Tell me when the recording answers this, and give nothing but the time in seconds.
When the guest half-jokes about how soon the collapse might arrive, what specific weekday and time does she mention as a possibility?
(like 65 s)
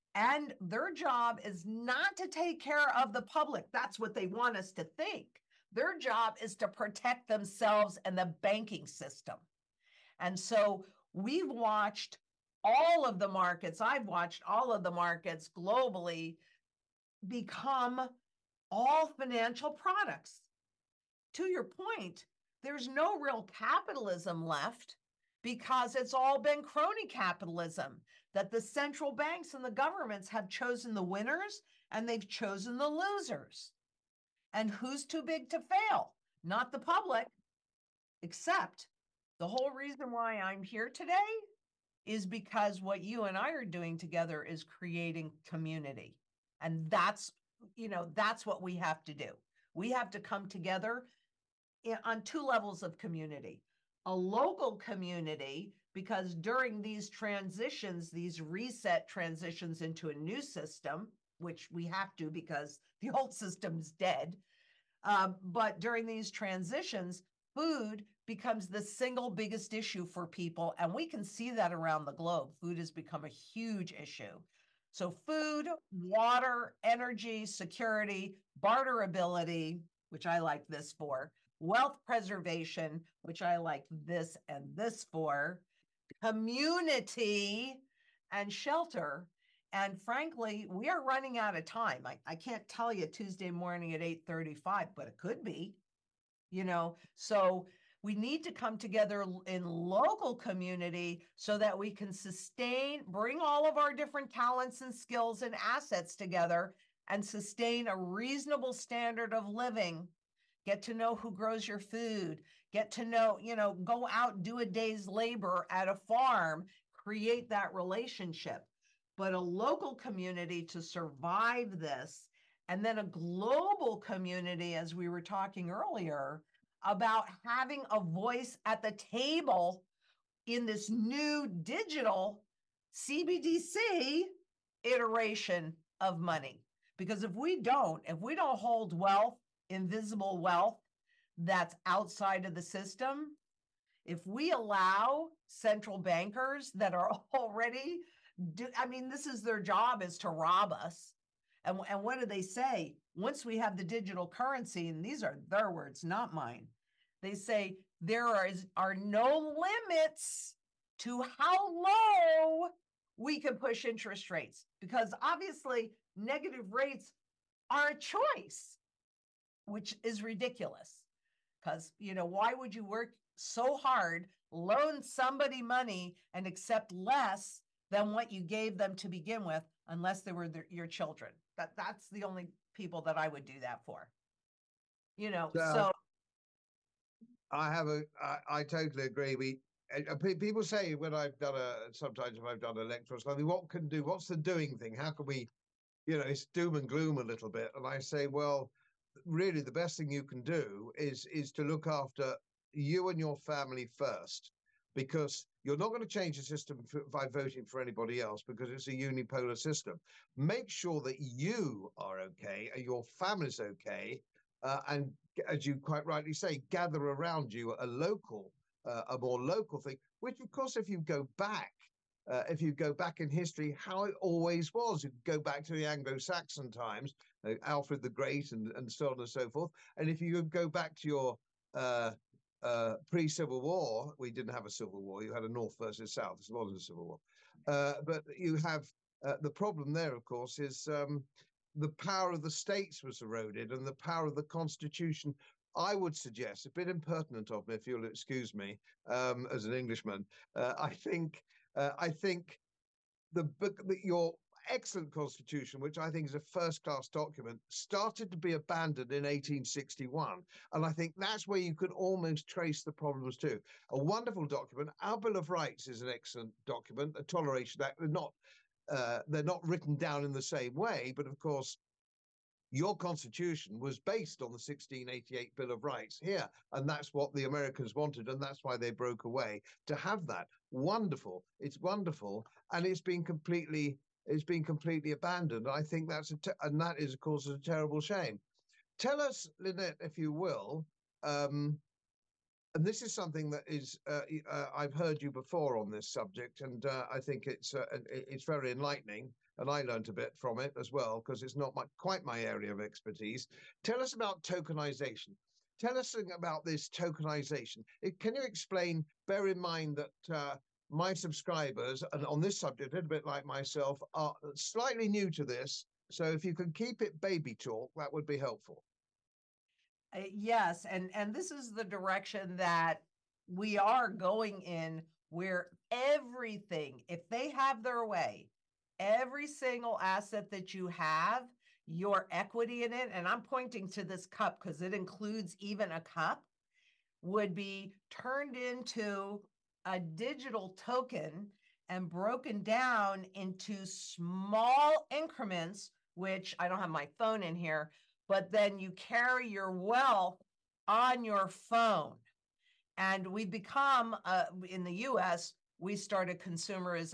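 93 s.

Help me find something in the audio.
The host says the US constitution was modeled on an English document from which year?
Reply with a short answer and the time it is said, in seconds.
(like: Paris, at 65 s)
1688, at 274 s.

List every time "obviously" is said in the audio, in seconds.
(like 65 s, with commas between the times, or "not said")
165 s.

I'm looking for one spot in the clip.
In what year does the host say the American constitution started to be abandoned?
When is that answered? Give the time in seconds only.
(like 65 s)
259 s.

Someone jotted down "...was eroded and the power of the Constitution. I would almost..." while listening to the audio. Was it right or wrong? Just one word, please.
wrong.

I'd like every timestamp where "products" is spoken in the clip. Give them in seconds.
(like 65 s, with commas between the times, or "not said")
19 s.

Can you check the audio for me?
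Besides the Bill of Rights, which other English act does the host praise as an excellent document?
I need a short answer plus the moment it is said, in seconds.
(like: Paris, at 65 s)
The Toleration Act, at 267 s.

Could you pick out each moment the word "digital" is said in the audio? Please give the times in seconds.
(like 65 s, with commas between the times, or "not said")
131 s, 153 s, 339 s.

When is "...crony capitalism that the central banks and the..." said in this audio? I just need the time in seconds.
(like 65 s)
26 s.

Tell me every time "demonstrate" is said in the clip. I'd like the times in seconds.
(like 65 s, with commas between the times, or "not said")
not said.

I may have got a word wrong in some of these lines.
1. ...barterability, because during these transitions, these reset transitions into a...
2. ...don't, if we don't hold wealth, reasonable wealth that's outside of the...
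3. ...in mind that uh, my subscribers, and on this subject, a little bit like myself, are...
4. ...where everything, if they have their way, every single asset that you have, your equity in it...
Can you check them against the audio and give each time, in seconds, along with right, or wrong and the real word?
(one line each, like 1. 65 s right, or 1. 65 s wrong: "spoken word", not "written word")
1. 54 s wrong: "community", not "barterability"
2. 137 s wrong: "invisible", not "reasonable"
3. 309 s right
4. 325 s right.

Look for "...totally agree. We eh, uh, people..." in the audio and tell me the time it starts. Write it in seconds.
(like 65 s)
188 s.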